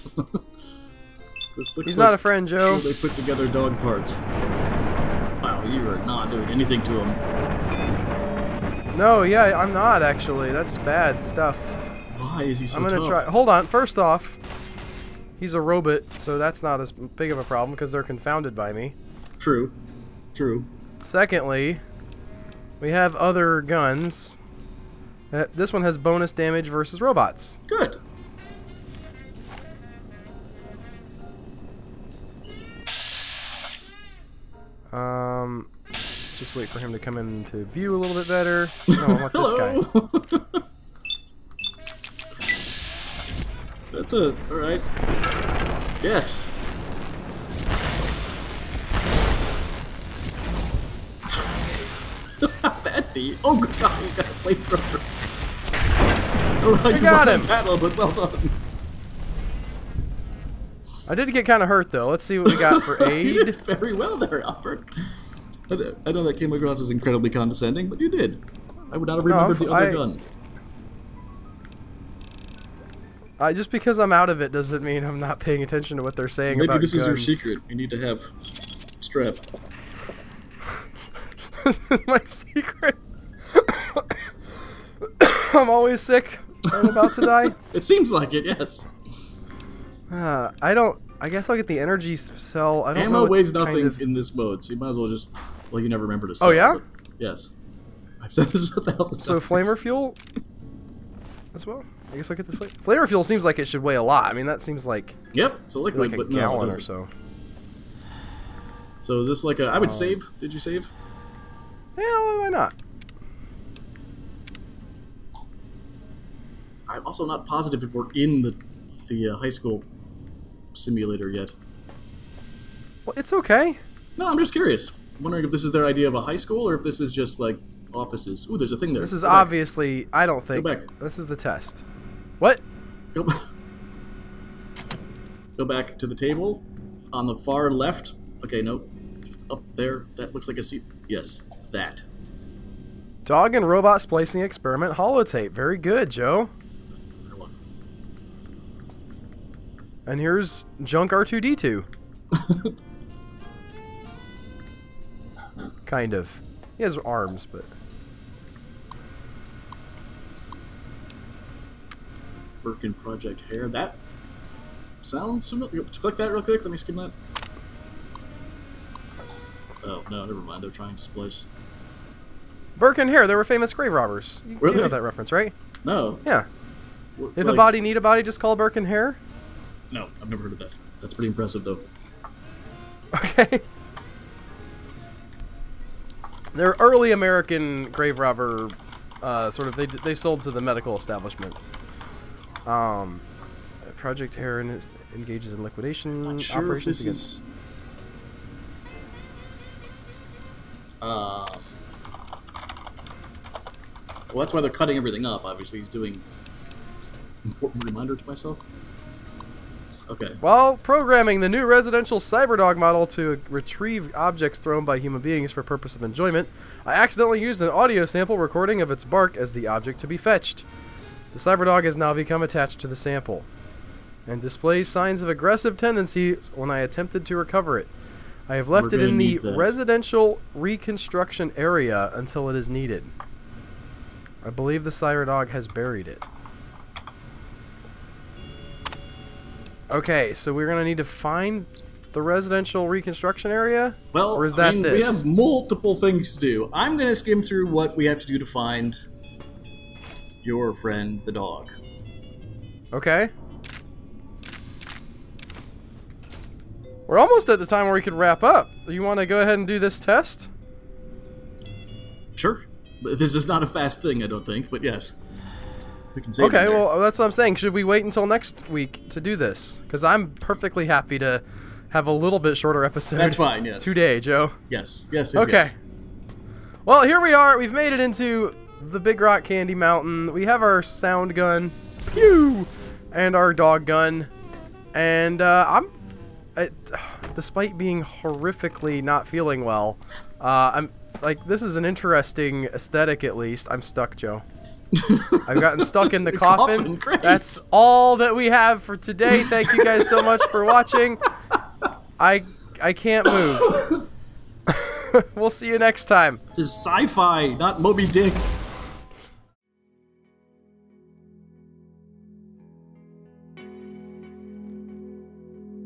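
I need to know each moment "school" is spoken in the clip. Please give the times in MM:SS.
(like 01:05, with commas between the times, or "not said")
01:59, 02:06.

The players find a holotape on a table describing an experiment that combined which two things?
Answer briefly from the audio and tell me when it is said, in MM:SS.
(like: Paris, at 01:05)
Dog and robot, at 02:23.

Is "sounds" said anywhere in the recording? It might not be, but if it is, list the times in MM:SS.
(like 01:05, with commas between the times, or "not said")
02:45, 04:40.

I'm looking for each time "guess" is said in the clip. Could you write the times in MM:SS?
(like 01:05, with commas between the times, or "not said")
01:31, 01:42.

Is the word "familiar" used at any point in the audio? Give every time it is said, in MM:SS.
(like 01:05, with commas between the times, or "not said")
02:45.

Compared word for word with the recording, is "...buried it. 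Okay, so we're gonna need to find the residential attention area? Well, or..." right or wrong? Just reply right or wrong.
wrong.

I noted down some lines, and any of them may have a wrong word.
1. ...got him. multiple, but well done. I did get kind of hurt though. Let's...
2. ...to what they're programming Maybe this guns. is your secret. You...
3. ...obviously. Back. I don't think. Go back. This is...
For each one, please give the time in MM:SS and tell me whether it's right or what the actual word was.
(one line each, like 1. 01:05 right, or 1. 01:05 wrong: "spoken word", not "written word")
1. 00:57 wrong: "battle", not "multiple"
2. 01:15 wrong: "saying", not "programming"
3. 02:09 right.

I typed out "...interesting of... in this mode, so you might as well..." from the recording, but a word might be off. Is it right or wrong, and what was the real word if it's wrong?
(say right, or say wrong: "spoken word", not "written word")
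wrong: "nothing", not "interesting".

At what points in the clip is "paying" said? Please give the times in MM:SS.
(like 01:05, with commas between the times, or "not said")
01:15.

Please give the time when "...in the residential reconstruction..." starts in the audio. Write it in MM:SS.
03:49.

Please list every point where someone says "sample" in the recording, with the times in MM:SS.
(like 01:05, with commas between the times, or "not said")
03:38, 03:42.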